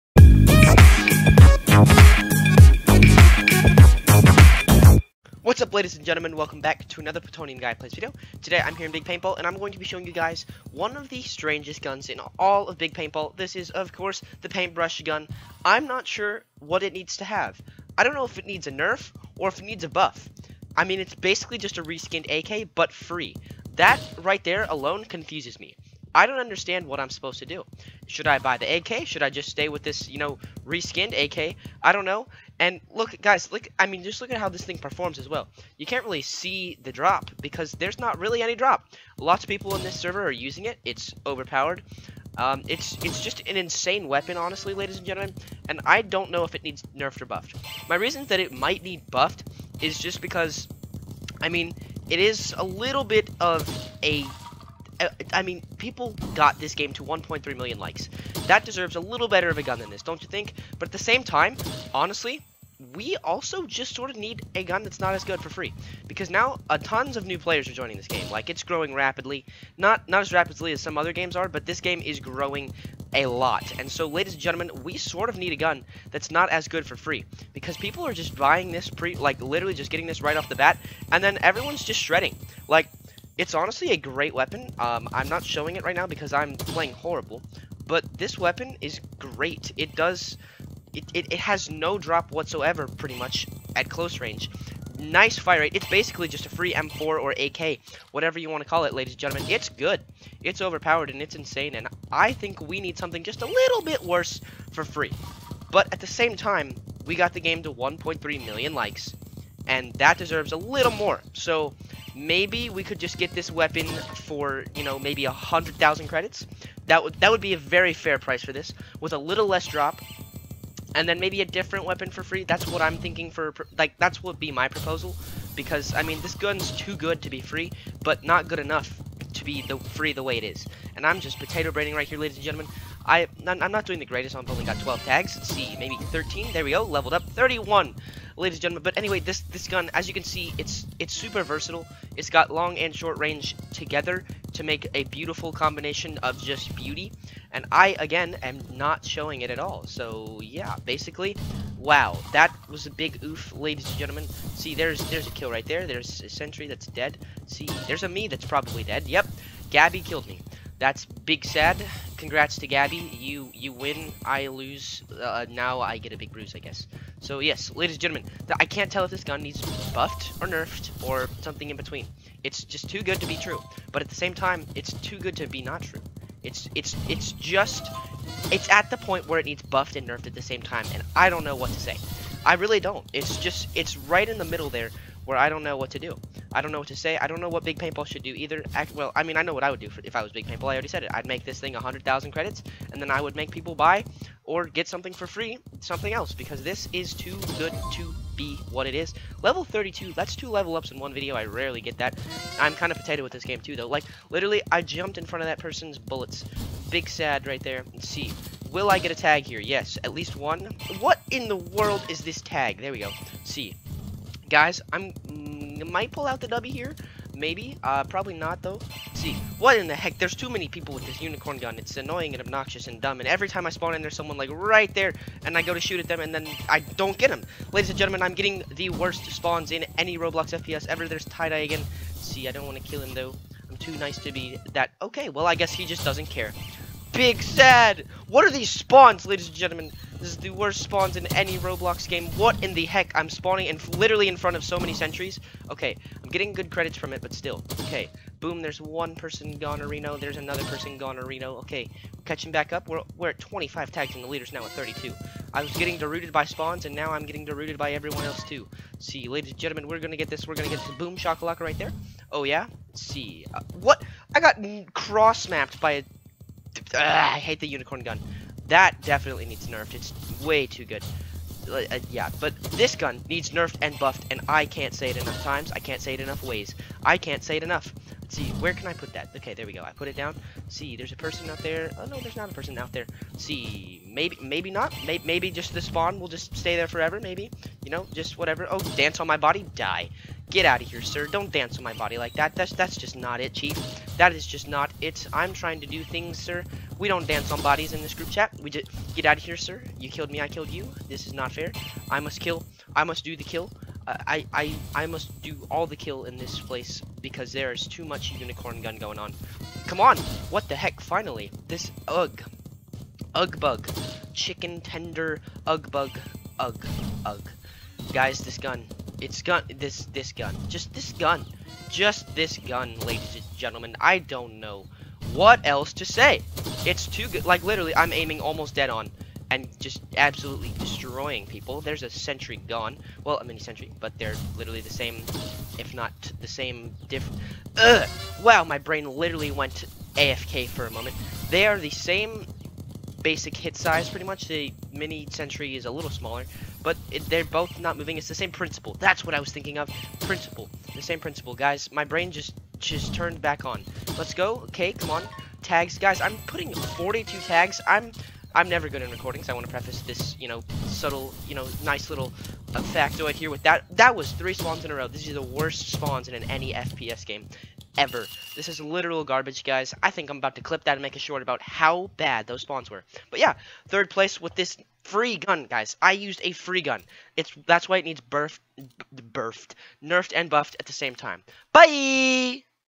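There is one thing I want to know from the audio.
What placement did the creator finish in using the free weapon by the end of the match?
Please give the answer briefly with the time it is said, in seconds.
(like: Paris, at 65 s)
Third place, at 373 s.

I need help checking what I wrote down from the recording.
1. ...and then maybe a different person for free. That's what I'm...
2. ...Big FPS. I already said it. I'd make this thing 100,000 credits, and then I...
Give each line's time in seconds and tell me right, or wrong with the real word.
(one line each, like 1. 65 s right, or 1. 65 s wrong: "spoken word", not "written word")
1. 120 s wrong: "weapon", not "person"
2. 190 s wrong: "Paintball", not "FPS".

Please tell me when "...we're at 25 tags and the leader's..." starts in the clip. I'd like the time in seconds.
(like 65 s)
253 s.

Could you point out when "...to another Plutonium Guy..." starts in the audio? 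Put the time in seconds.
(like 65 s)
6 s.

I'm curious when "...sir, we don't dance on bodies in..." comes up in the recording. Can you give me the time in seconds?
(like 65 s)
296 s.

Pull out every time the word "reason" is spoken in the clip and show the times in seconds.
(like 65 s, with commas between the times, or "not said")
47 s.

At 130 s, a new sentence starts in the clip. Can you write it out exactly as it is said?
And I'm just potato braiding right here, ladies and gentlemen.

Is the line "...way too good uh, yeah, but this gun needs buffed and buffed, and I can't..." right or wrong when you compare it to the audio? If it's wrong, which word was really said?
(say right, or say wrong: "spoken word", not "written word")
wrong: "nerfed", not "buffed".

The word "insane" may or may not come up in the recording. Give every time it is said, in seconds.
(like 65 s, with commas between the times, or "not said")
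43 s, 101 s.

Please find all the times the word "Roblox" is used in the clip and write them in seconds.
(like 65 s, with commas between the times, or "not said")
230 s, 241 s.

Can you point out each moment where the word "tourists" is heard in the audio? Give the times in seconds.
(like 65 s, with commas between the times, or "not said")
not said.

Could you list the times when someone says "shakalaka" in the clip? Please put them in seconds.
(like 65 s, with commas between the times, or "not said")
261 s.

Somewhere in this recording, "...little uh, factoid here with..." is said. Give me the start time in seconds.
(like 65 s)
362 s.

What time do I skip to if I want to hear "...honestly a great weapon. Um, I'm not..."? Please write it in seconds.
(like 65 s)
83 s.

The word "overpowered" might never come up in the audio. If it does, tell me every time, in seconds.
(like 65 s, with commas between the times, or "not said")
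41 s, 100 s.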